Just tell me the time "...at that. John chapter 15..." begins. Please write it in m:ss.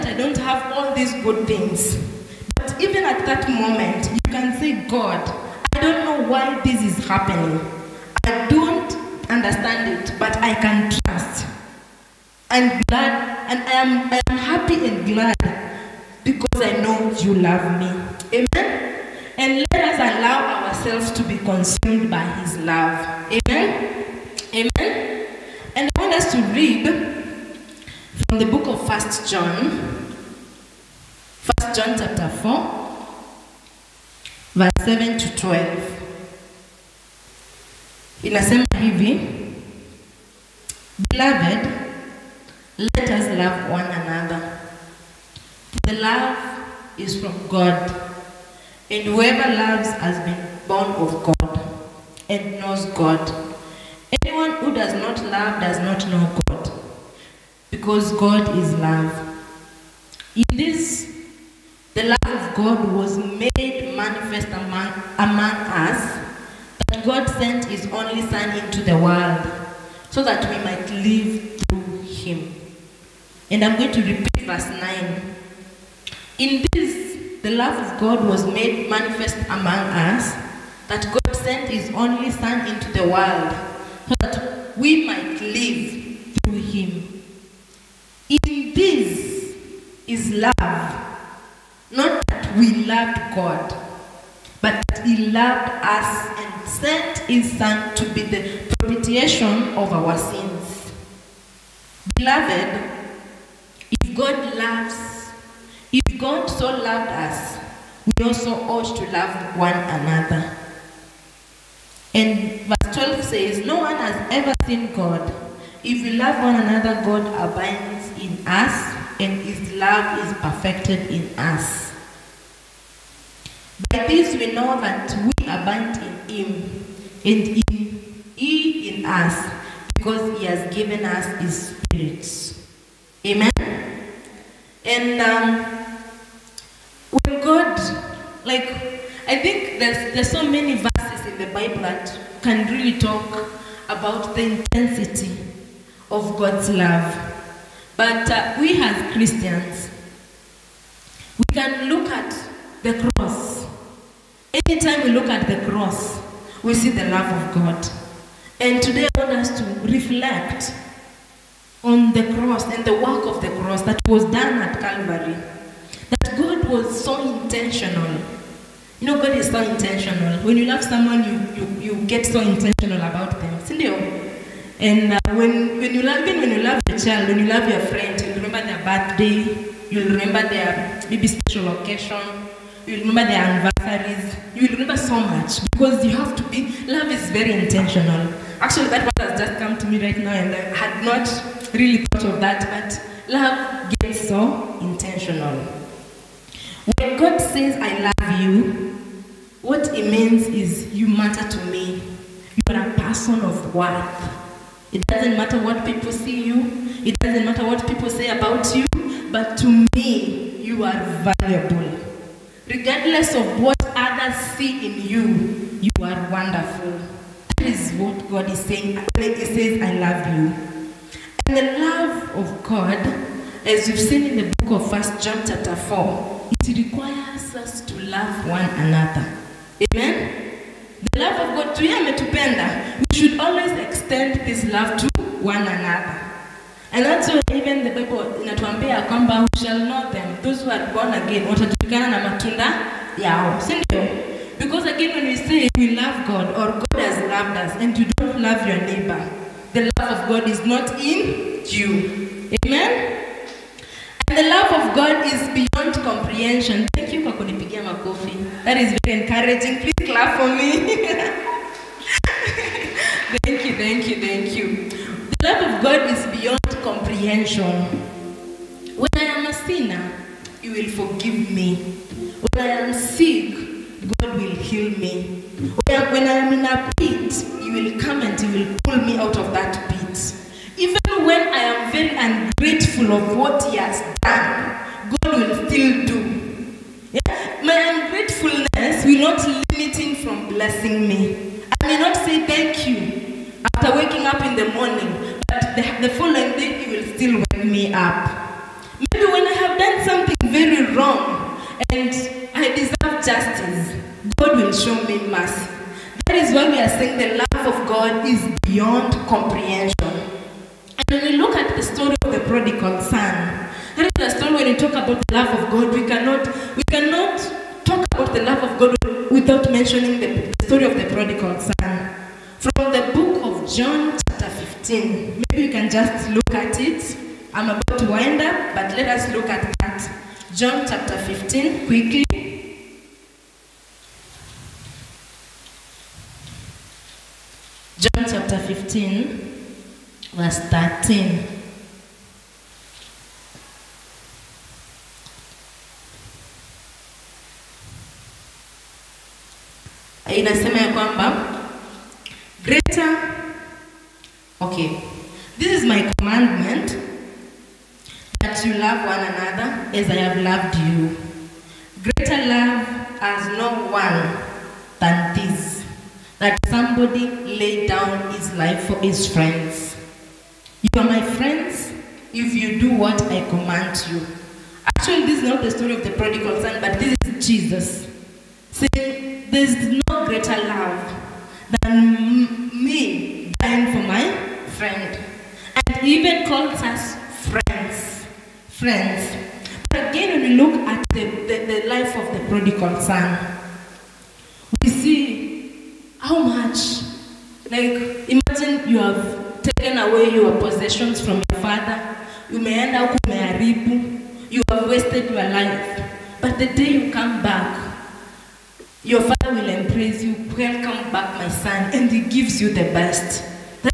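5:29.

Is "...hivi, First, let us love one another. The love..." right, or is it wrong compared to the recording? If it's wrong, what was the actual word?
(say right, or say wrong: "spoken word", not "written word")
wrong: "Beloved", not "First".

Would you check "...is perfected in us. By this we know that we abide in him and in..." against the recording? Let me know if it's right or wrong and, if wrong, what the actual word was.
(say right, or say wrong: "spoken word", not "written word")
right.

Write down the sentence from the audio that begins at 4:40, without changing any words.
Even when I am very ungrateful of what he has done, God will still do.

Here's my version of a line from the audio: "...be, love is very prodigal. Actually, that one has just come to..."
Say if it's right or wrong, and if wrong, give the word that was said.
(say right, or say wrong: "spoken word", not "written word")
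wrong: "intentional", not "prodigal".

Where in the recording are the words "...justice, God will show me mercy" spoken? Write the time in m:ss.
5:03.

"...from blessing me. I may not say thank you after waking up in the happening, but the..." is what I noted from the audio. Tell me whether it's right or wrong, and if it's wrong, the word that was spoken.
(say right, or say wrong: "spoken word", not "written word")
wrong: "morning", not "happening".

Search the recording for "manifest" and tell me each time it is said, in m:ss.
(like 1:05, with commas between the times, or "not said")
1:03, 1:18.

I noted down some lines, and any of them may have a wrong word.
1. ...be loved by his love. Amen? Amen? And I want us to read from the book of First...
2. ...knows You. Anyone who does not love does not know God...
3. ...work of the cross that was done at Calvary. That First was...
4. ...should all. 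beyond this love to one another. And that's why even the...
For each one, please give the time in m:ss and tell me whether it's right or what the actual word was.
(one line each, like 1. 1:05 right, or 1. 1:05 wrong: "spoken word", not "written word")
1. 0:21 wrong: "consumed", not "loved"
2. 0:52 wrong: "God", not "You"
3. 2:42 wrong: "God", not "First"
4. 3:53 wrong: "extend", not "beyond".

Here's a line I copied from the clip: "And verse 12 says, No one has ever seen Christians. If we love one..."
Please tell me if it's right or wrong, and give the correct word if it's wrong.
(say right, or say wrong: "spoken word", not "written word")
wrong: "God", not "Christians".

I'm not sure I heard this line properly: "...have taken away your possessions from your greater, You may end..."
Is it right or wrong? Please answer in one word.
wrong.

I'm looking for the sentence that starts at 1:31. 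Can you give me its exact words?
Not that we loved God, but that He loved us and sent His Son to be the propitiation of our sins.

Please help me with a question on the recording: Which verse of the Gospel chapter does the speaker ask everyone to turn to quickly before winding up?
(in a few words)
Verse 13.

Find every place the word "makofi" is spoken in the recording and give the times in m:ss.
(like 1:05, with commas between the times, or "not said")
4:17.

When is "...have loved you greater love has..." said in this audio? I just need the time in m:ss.
6:00.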